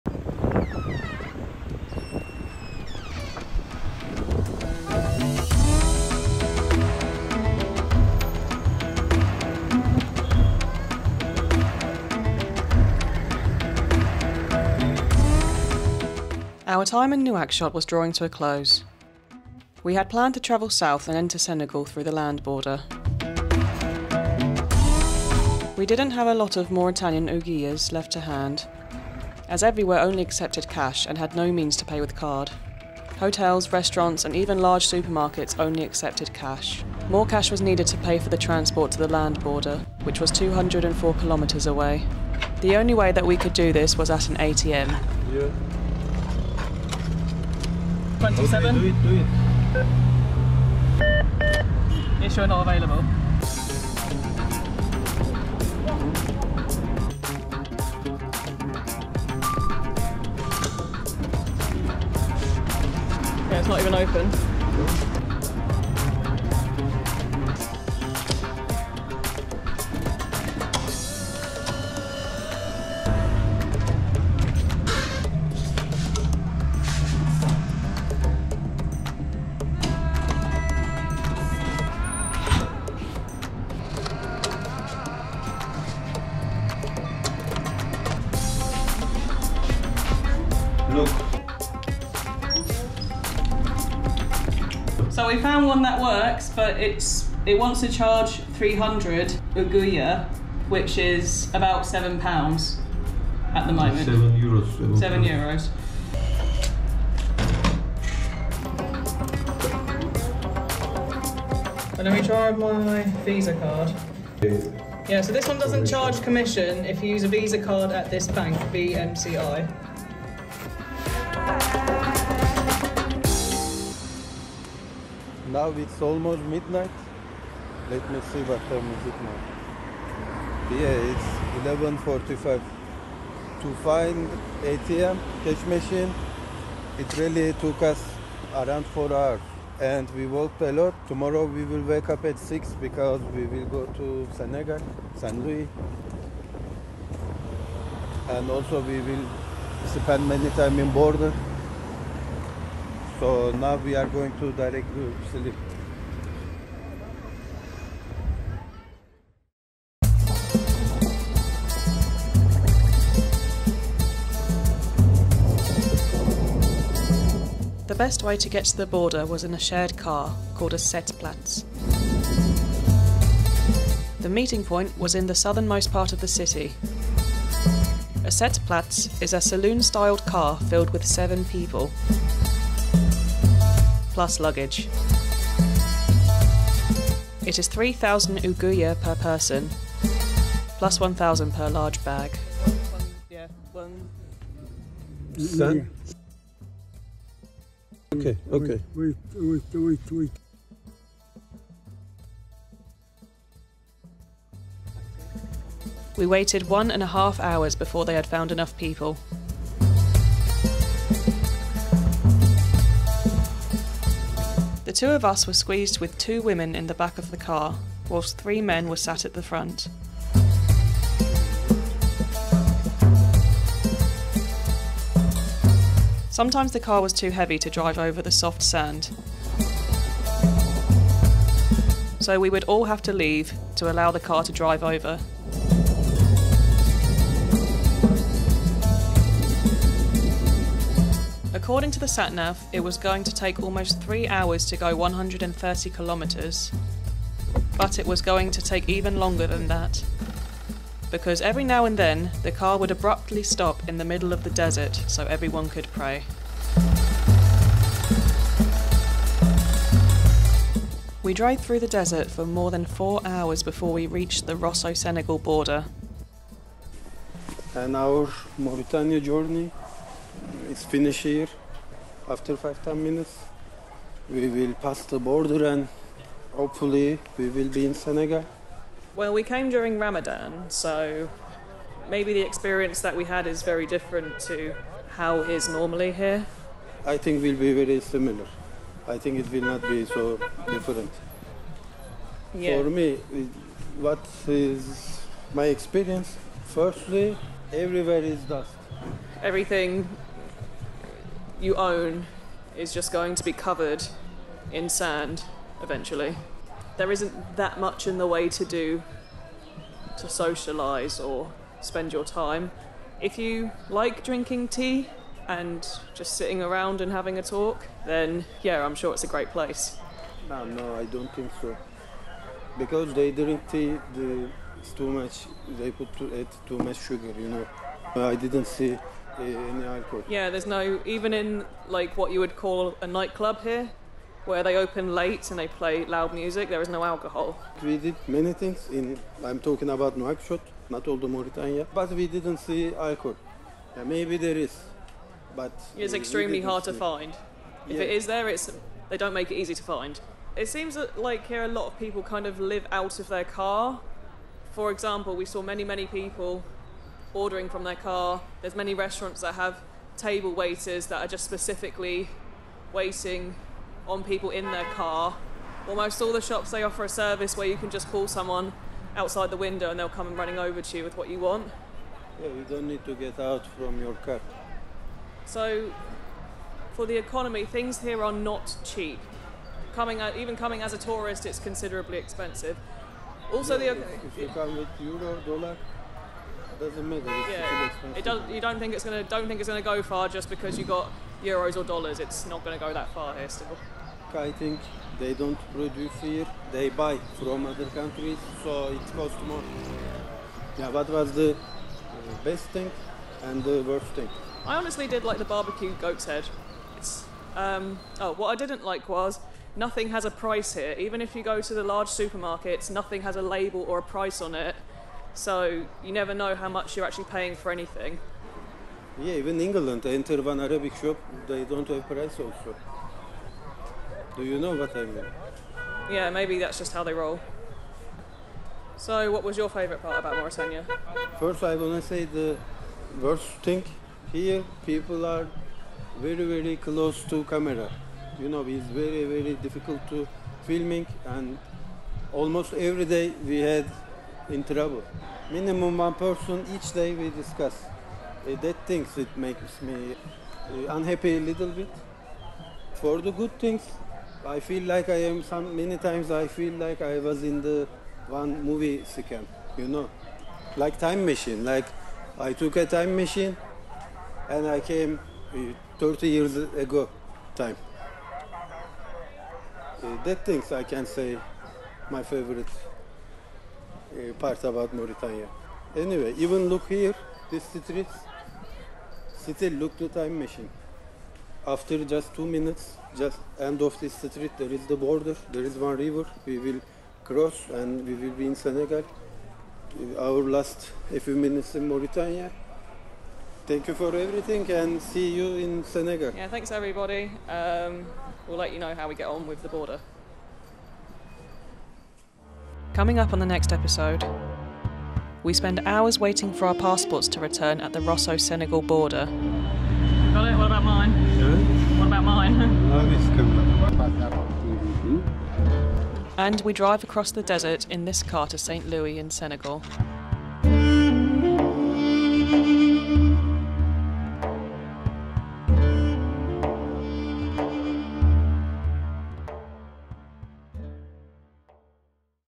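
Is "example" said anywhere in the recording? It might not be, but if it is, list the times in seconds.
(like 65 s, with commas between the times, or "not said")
354 s.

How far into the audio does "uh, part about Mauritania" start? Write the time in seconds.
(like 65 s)
474 s.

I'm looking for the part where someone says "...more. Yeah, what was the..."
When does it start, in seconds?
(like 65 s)
399 s.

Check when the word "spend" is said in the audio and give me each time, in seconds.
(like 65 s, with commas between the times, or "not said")
149 s, 311 s, 505 s.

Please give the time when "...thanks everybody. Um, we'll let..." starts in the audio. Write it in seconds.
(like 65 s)
496 s.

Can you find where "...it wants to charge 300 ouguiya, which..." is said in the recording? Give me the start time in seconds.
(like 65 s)
97 s.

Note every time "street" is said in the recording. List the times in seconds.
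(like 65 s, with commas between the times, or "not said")
477 s, 484 s.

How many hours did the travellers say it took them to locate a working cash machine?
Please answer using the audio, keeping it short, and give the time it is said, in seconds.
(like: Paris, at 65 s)
4, at 138 s.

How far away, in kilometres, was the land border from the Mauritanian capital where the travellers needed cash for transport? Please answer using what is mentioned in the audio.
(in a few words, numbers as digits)
204.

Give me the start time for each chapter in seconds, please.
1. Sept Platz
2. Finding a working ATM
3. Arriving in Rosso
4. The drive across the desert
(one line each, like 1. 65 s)
1. 170 s
2. 39 s
3. 267 s
4. 221 s.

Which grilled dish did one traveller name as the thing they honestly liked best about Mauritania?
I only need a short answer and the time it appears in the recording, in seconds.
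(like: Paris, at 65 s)
Barbecue goat's head, at 405 s.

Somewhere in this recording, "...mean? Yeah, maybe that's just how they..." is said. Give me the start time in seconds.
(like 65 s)
425 s.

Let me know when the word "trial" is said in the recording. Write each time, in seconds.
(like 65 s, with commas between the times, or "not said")
not said.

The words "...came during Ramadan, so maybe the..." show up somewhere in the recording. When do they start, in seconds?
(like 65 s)
279 s.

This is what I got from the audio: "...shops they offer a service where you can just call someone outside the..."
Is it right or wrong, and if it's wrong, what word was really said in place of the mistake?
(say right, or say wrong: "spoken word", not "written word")
right.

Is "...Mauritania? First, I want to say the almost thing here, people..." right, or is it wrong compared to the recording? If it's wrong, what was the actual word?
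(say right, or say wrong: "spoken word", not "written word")
wrong: "worst", not "almost".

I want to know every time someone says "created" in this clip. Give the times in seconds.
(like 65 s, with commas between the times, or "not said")
not said.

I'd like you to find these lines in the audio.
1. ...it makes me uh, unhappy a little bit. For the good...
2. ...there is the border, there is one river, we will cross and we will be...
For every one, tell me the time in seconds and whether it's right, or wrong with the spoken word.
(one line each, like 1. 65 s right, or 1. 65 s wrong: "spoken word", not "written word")
1. 449 s right
2. 484 s right.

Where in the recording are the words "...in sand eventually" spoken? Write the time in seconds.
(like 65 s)
304 s.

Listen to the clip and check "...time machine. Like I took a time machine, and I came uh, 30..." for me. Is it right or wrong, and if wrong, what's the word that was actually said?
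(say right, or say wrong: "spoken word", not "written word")
right.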